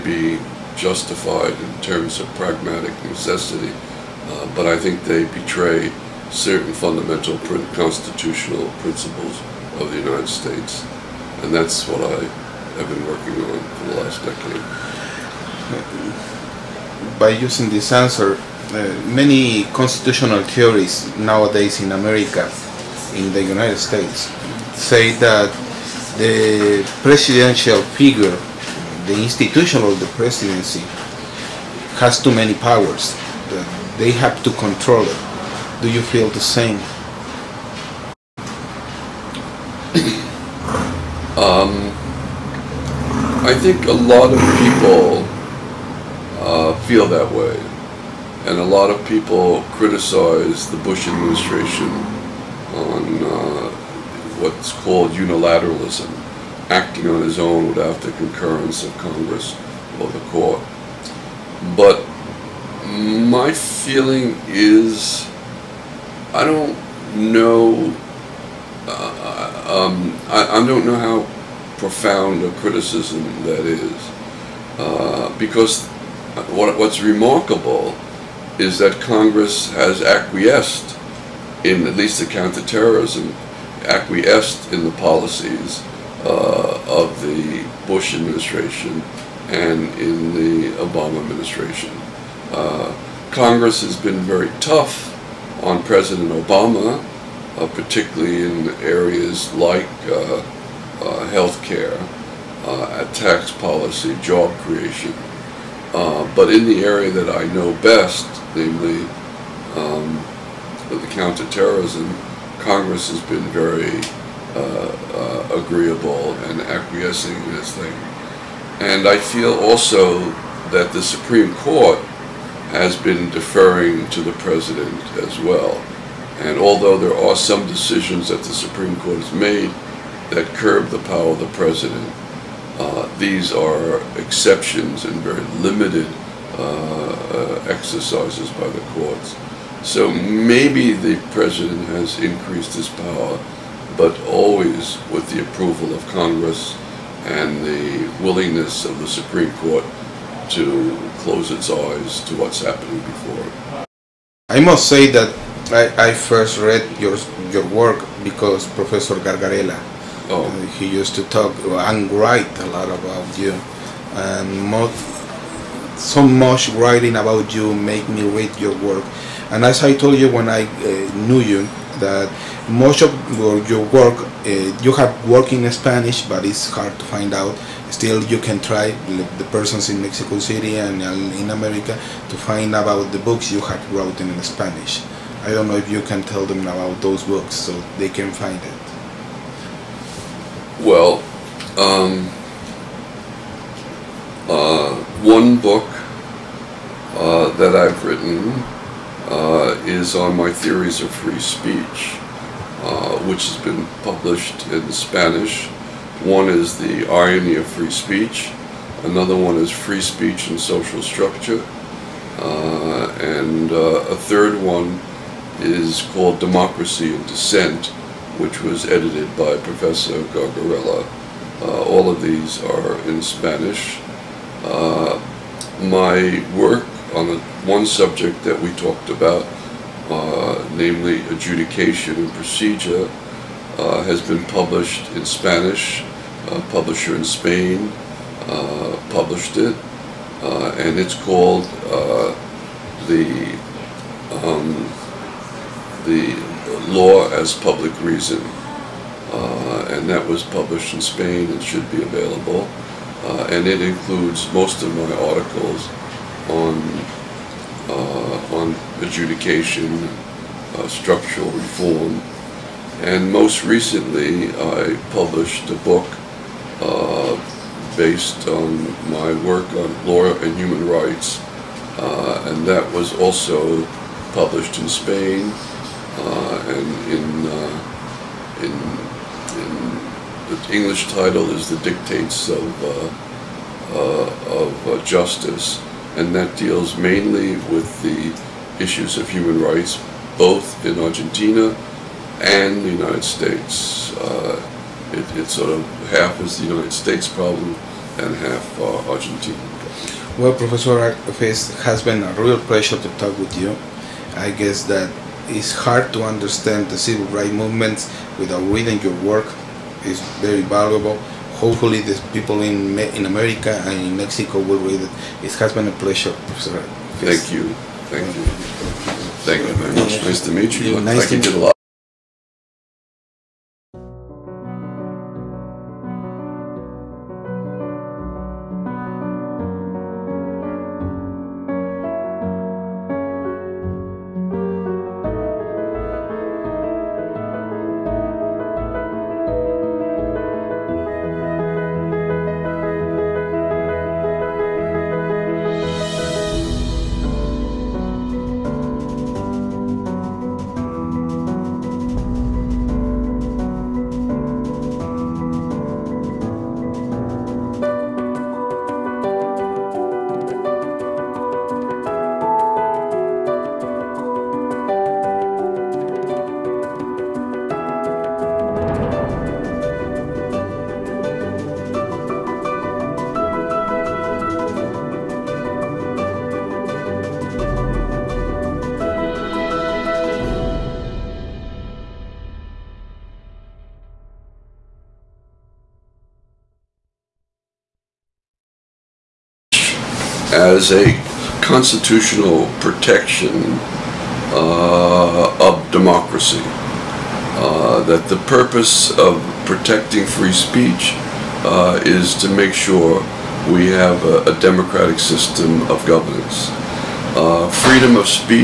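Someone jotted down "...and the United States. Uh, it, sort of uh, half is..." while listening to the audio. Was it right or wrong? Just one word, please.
right.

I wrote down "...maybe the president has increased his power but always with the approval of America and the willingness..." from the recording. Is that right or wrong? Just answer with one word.
wrong.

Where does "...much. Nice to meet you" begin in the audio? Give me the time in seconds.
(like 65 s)
319 s.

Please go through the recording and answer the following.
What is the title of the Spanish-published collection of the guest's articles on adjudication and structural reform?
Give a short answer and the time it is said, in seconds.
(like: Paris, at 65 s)
The Law as Public Reason, at 246 s.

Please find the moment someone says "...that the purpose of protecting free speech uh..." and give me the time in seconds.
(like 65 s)
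398 s.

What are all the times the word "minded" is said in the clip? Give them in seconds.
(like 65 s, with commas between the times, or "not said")
not said.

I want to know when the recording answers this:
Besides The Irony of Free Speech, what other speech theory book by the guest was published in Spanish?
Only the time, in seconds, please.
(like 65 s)
209 s.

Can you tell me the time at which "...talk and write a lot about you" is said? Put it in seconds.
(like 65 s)
161 s.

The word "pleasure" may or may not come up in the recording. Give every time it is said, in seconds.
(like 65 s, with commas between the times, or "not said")
302 s, 316 s.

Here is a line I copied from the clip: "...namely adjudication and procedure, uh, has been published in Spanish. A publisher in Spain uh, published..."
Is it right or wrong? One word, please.
right.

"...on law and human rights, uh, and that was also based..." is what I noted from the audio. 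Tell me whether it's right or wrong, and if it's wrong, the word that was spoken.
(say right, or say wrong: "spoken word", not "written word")
wrong: "published", not "based".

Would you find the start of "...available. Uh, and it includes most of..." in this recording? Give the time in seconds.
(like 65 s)
252 s.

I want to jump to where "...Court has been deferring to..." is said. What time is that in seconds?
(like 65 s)
121 s.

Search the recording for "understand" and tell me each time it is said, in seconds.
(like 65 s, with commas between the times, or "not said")
306 s.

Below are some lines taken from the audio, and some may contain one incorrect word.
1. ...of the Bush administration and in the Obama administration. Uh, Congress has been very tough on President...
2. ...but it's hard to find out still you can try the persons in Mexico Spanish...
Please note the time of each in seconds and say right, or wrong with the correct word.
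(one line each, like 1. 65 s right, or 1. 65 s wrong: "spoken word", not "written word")
1. 86 s right
2. 176 s wrong: "City", not "Spanish".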